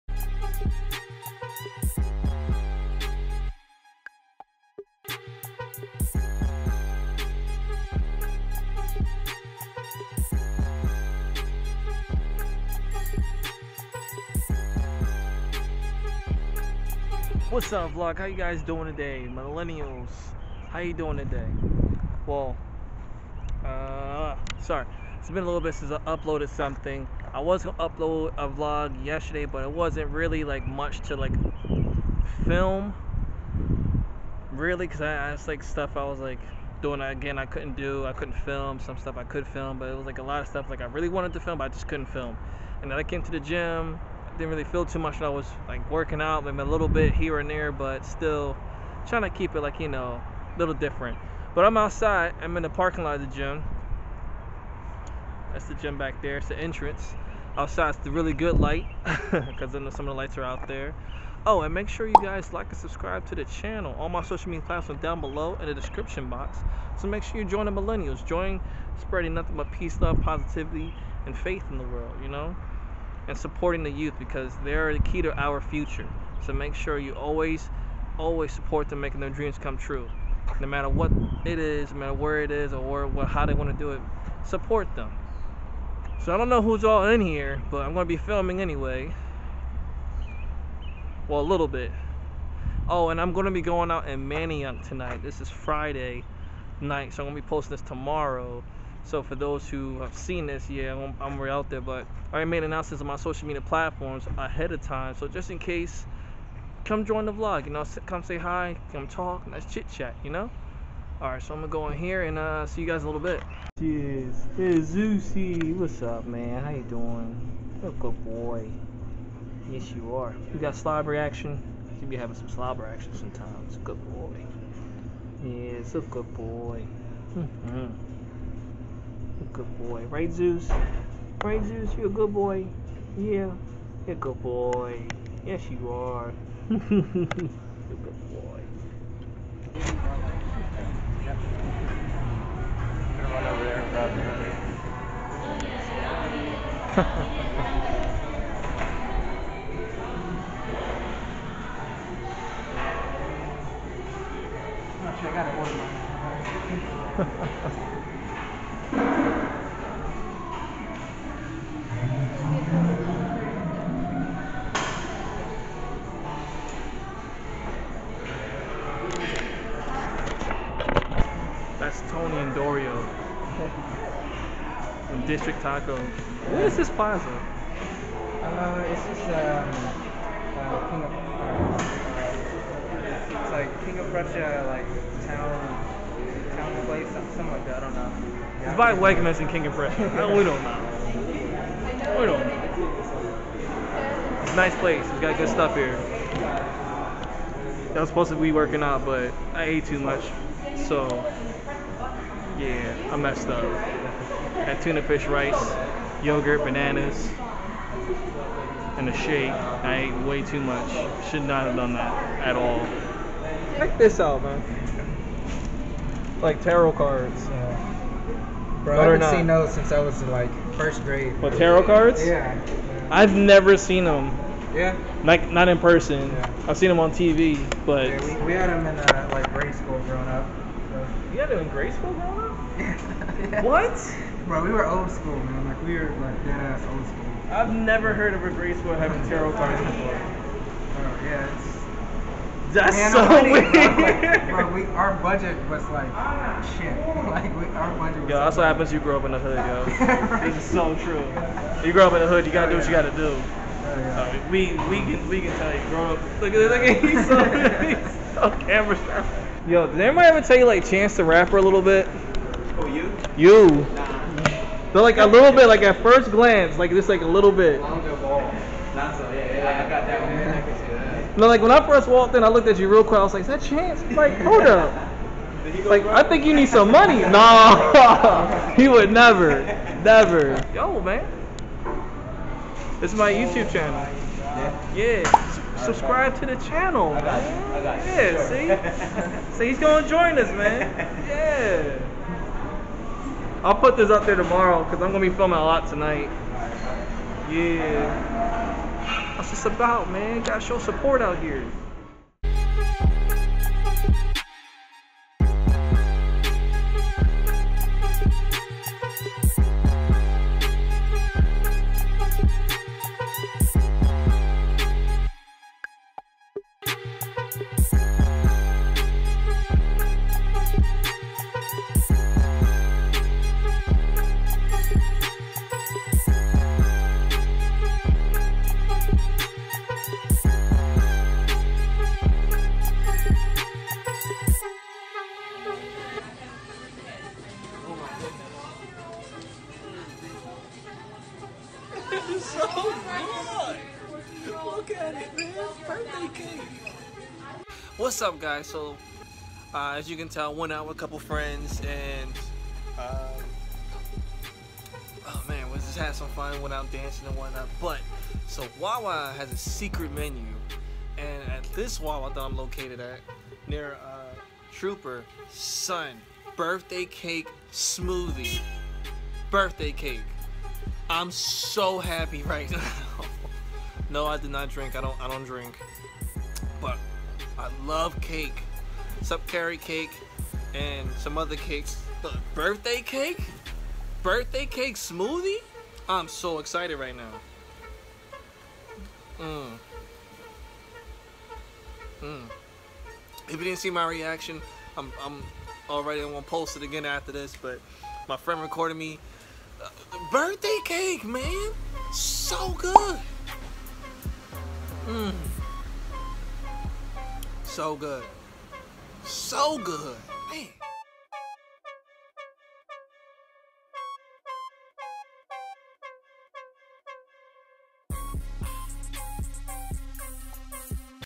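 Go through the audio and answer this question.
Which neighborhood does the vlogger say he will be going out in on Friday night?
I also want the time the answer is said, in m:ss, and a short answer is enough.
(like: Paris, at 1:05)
Manayunk, at 1:34.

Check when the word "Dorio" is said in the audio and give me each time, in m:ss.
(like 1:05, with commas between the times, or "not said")
2:52.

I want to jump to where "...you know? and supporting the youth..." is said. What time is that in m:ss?
1:12.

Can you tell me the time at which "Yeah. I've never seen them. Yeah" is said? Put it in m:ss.
3:42.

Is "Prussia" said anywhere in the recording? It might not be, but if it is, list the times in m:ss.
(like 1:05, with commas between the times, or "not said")
3:04, 3:09.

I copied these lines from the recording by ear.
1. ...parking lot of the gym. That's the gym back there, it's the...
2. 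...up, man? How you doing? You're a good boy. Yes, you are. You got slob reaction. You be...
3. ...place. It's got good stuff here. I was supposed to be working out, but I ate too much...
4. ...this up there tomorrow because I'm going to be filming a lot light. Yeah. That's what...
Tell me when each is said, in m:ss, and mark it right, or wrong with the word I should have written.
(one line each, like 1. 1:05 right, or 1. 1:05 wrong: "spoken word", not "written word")
1. 0:52 right
2. 1:56 right
3. 3:14 right
4. 4:53 wrong: "tonight", not "light".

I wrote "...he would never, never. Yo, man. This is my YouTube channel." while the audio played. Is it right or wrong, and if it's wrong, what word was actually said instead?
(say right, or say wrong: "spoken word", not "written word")
right.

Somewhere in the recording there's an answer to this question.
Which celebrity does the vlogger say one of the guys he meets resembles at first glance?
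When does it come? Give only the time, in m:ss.
4:20.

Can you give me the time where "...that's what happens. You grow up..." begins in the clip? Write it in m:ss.
4:08.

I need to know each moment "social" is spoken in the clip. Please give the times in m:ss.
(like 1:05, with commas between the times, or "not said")
1:04, 1:43.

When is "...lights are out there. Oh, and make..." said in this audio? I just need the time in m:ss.
1:00.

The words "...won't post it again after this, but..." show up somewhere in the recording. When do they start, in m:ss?
6:36.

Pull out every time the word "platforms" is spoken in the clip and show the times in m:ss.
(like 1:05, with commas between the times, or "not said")
1:04, 1:43.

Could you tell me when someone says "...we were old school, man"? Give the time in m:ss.
3:54.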